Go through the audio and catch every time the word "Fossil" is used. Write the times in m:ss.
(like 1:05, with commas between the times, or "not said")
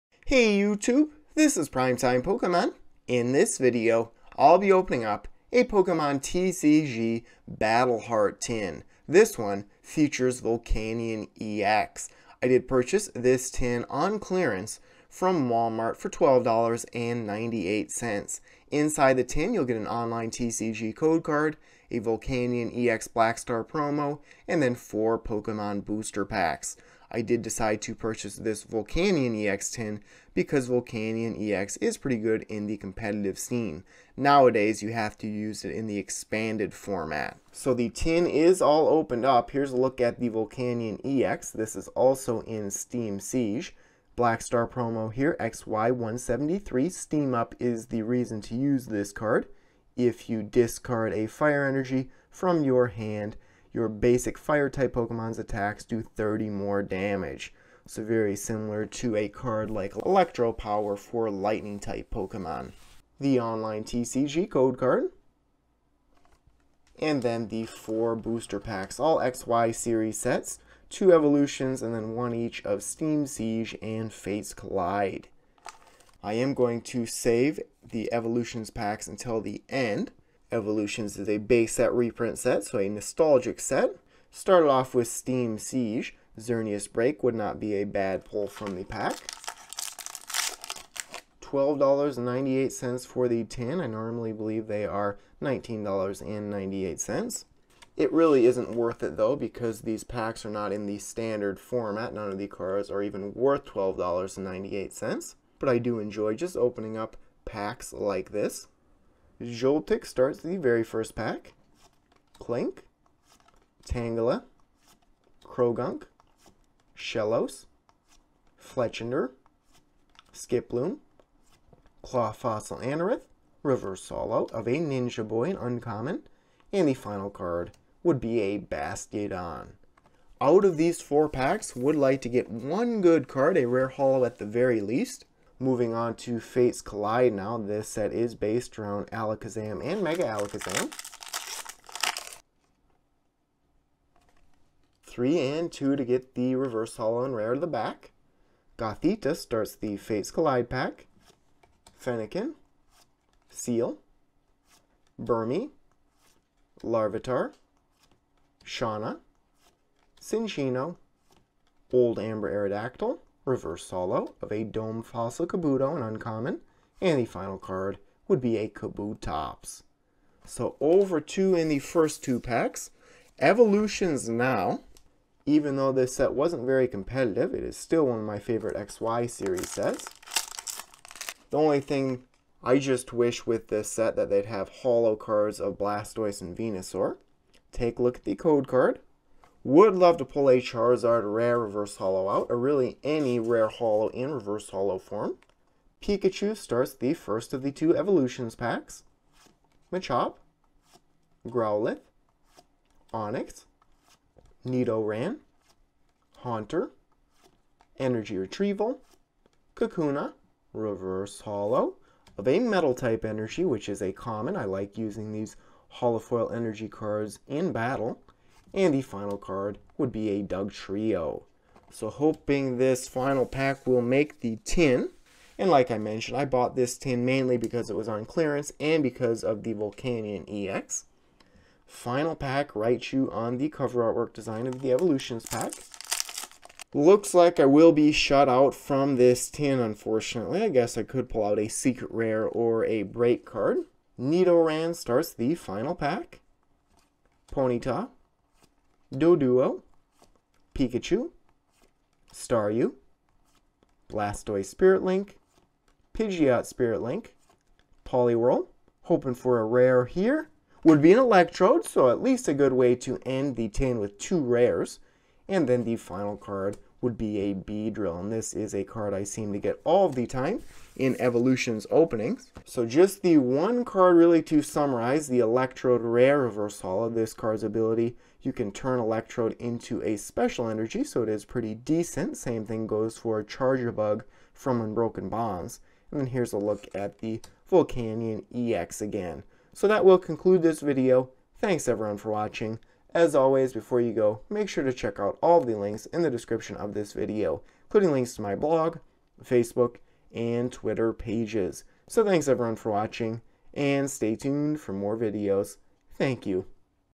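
2:02, 2:45.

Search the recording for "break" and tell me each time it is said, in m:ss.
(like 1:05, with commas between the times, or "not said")
1:26, 4:03.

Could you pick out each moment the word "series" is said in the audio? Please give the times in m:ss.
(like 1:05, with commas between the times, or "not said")
1:09, 2:59.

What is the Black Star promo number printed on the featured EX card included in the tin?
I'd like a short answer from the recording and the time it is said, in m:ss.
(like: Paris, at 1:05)
XY173, at 0:45.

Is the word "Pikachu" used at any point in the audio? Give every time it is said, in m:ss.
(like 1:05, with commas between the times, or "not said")
3:16, 4:10.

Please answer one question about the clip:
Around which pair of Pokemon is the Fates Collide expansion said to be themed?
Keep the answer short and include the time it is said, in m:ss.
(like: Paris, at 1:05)
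Alakazam and Mega Alakazam, at 2:19.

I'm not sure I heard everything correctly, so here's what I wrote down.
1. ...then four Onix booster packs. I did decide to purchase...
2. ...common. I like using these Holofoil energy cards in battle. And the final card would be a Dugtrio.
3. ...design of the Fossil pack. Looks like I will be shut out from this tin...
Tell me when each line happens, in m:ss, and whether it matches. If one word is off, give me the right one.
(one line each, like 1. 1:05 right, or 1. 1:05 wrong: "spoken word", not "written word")
1. 0:24 wrong: "Pokemon", not "Onix"
2. 3:34 right
3. 3:54 wrong: "Evolutions", not "Fossil".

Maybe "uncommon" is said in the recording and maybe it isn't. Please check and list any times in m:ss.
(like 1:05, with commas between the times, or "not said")
2:05, 2:46.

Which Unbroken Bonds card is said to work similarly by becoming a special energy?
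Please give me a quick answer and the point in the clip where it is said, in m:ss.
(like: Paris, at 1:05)
Charjabug, at 4:43.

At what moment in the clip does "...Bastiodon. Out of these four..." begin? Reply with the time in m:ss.
2:08.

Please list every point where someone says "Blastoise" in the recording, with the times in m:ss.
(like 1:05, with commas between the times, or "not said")
3:05, 4:14.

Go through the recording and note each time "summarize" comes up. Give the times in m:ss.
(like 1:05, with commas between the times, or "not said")
4:34.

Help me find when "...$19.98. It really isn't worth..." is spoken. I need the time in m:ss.
1:35.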